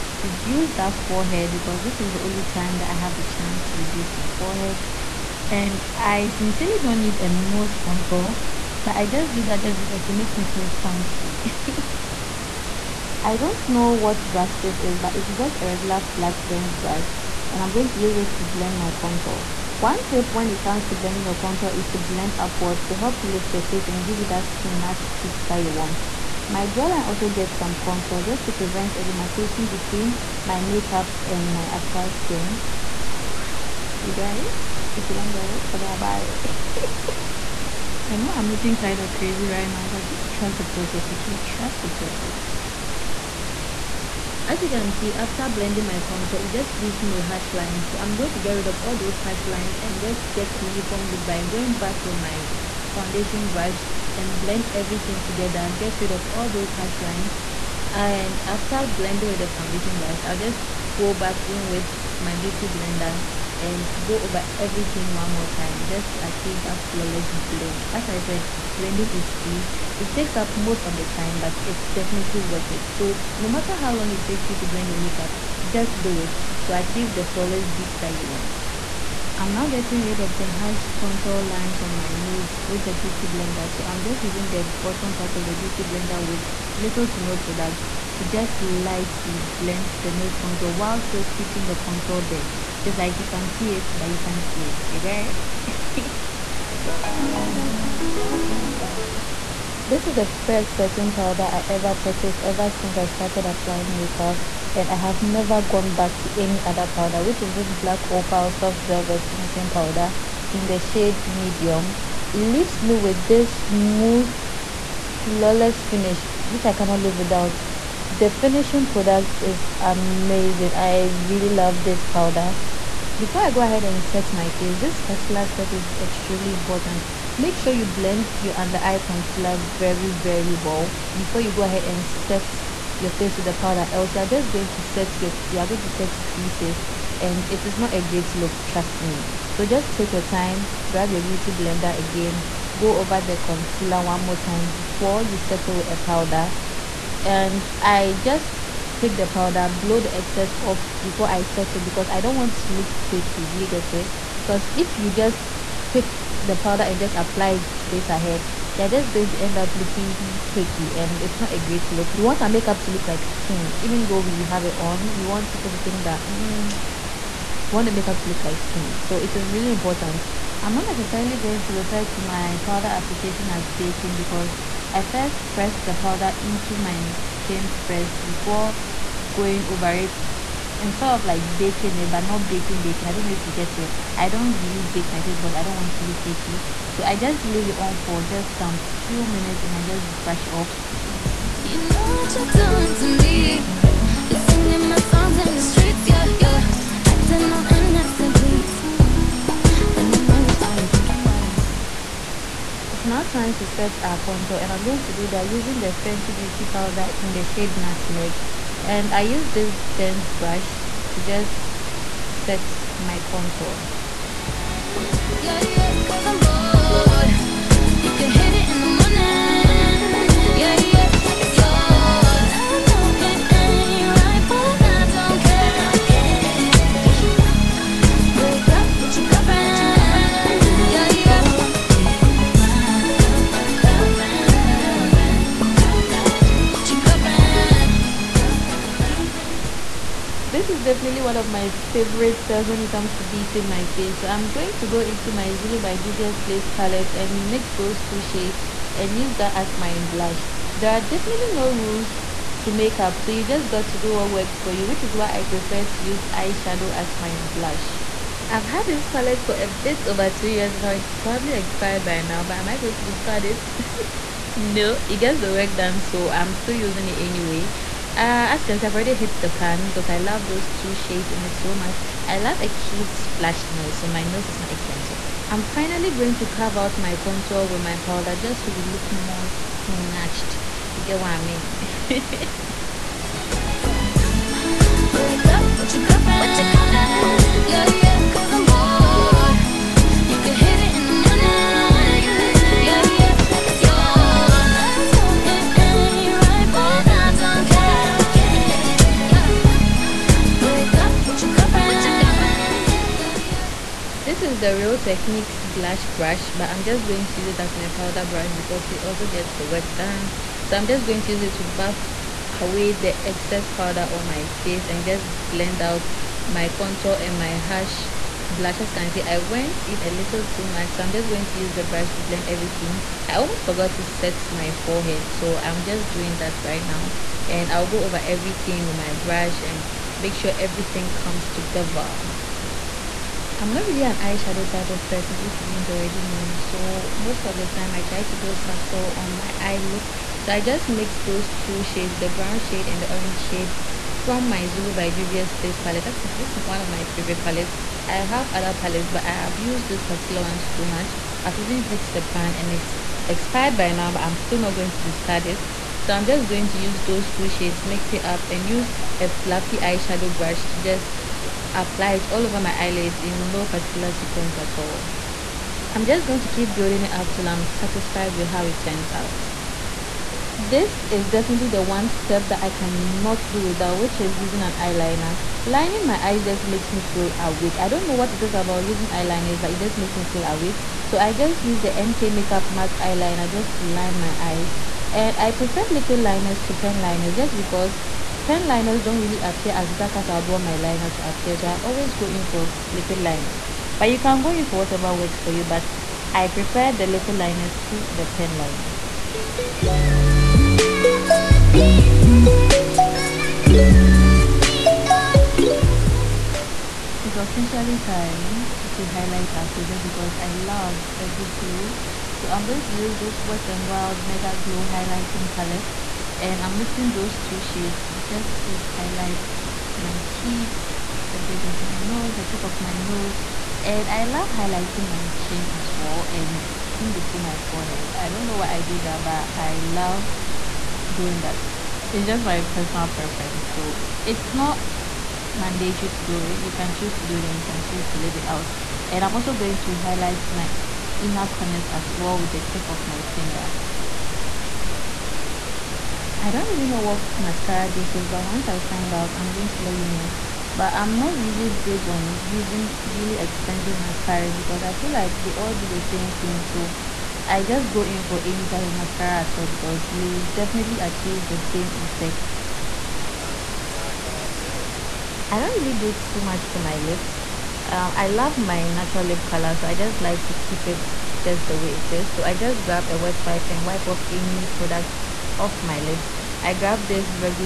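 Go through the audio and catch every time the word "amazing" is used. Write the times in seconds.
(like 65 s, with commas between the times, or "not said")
119 s.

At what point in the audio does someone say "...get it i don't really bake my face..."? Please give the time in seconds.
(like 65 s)
183 s.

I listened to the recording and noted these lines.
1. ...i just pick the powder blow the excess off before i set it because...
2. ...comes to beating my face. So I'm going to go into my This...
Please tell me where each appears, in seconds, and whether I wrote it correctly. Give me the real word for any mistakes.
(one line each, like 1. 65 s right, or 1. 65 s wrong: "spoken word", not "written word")
1. 147 s right
2. 242 s wrong: "Zulu", not "This".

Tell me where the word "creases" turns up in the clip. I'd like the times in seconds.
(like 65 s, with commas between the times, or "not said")
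136 s.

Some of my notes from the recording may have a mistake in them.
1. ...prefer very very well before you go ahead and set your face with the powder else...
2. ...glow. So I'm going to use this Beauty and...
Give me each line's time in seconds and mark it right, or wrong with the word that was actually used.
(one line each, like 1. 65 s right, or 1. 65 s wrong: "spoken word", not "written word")
1. 128 s wrong: "concealer", not "prefer"
2. 411 s wrong: "Wet", not "Beauty".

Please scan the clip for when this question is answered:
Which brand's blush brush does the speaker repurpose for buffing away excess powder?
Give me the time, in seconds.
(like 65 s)
304 s.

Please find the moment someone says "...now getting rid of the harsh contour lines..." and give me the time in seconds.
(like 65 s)
79 s.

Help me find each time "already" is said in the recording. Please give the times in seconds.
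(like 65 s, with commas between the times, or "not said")
268 s, 335 s.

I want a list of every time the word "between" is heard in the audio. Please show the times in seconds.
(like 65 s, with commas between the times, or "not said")
29 s, 427 s.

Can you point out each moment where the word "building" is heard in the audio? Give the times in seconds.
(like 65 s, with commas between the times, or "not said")
366 s.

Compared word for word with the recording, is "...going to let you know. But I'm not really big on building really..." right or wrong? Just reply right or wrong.
wrong.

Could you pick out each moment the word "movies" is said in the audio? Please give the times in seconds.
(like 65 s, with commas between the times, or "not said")
not said.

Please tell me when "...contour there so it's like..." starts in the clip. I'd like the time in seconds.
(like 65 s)
91 s.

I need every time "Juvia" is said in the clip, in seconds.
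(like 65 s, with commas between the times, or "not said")
245 s, 345 s.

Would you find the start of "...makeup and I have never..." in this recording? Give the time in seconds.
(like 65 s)
103 s.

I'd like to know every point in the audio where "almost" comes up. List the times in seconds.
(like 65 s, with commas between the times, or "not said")
323 s.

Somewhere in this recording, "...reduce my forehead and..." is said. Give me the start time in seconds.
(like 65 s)
3 s.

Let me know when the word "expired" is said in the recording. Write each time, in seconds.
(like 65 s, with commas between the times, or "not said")
261 s, 353 s.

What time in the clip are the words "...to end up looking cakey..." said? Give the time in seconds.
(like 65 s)
159 s.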